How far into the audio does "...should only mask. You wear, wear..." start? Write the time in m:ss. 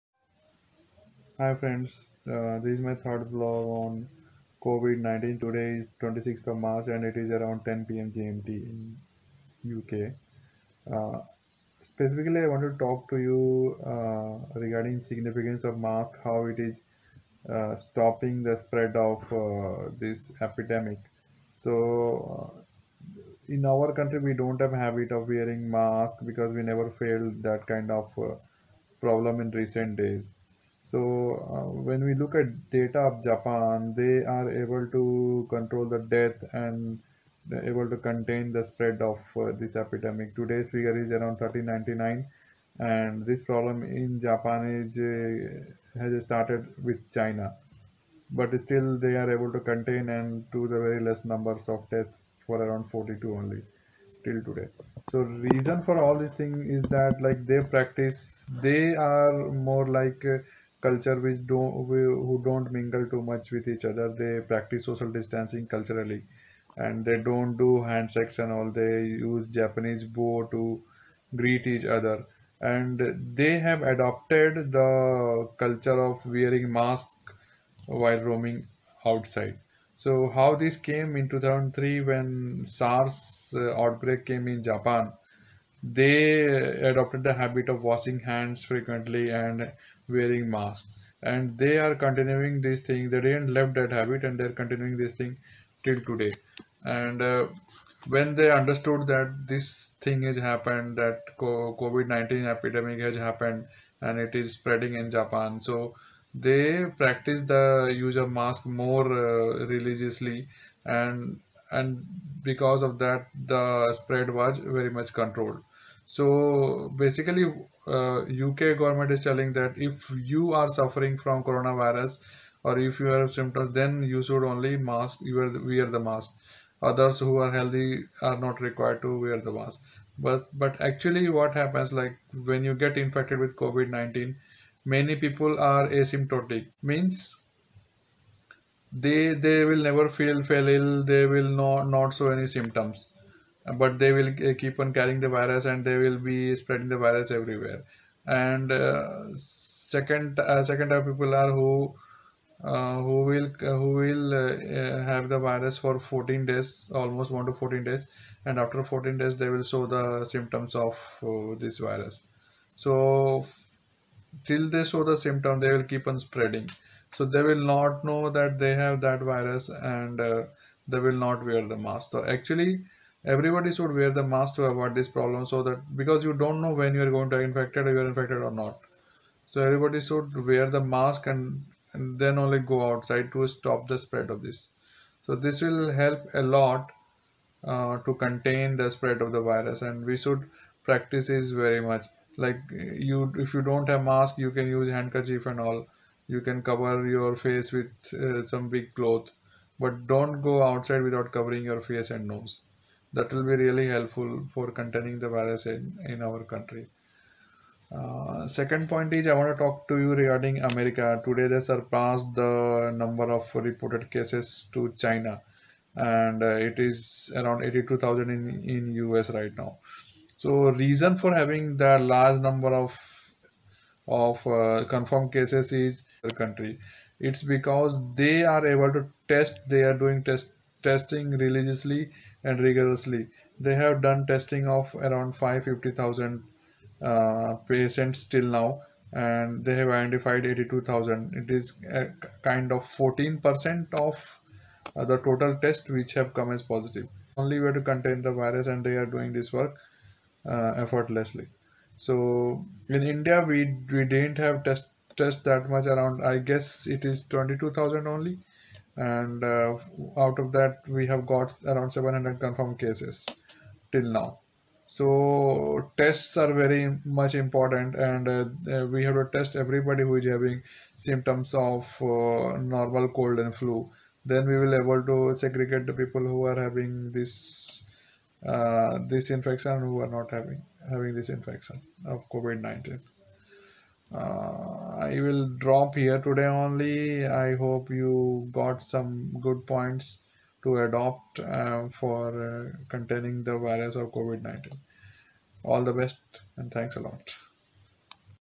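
2:04.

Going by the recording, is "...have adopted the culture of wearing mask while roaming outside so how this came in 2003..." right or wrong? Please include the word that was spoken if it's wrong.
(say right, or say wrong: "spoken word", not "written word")
right.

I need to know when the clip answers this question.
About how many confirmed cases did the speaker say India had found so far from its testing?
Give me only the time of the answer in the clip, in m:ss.
4:21.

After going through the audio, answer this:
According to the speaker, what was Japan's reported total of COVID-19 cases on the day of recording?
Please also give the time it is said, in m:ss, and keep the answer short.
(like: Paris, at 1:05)
1399, at 0:41.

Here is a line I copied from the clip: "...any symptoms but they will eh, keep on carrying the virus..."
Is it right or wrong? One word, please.
right.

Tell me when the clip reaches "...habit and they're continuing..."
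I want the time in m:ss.
1:33.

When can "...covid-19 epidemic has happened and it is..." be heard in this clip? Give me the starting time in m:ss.
1:41.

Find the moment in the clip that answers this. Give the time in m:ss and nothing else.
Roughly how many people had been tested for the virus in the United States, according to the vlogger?
3:55.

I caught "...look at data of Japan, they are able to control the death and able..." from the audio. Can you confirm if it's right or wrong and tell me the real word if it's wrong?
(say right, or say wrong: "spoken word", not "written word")
right.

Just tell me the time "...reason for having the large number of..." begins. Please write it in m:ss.
3:40.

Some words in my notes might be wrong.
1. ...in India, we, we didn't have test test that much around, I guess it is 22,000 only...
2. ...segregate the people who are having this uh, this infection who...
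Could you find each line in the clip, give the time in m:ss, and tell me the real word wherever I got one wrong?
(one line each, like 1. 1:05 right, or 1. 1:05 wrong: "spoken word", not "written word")
1. 4:12 right
2. 4:35 right.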